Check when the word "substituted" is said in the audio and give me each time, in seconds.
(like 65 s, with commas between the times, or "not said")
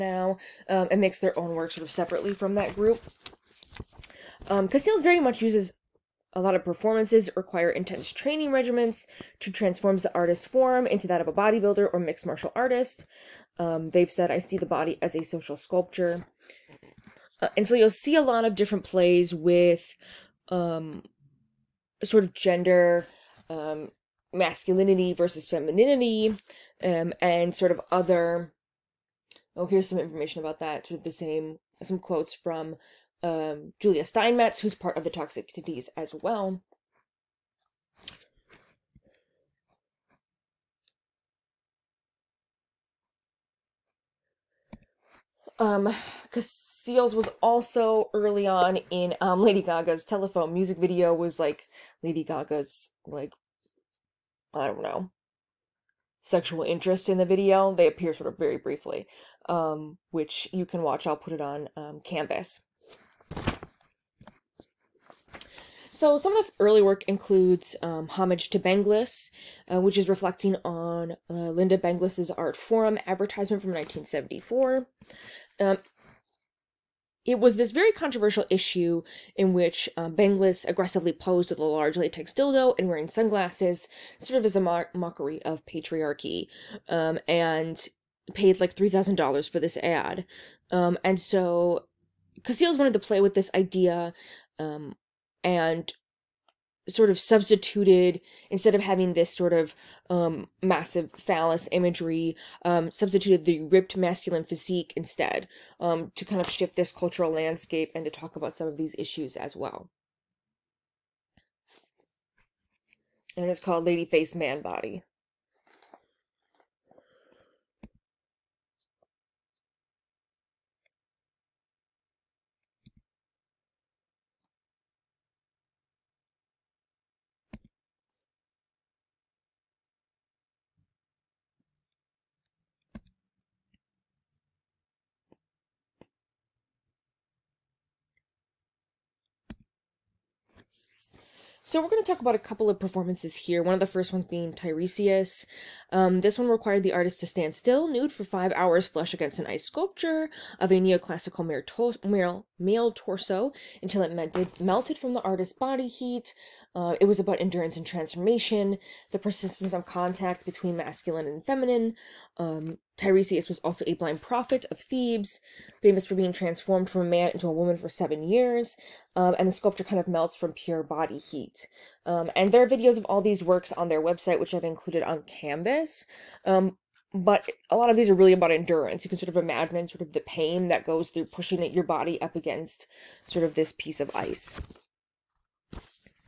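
97 s, 102 s.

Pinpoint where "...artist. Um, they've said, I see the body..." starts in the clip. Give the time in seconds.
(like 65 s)
12 s.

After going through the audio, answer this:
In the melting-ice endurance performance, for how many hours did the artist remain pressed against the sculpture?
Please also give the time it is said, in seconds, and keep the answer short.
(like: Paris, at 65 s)
5, at 148 s.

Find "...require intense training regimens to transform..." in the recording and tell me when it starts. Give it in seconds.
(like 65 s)
7 s.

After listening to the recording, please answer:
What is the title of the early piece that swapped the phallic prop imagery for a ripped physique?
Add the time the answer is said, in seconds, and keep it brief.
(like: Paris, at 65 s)
Lady Face Man Body, at 113 s.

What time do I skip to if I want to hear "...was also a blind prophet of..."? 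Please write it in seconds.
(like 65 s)
163 s.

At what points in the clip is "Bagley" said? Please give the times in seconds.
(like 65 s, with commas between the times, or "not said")
not said.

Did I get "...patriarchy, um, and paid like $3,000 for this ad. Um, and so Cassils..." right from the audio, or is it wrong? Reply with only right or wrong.
right.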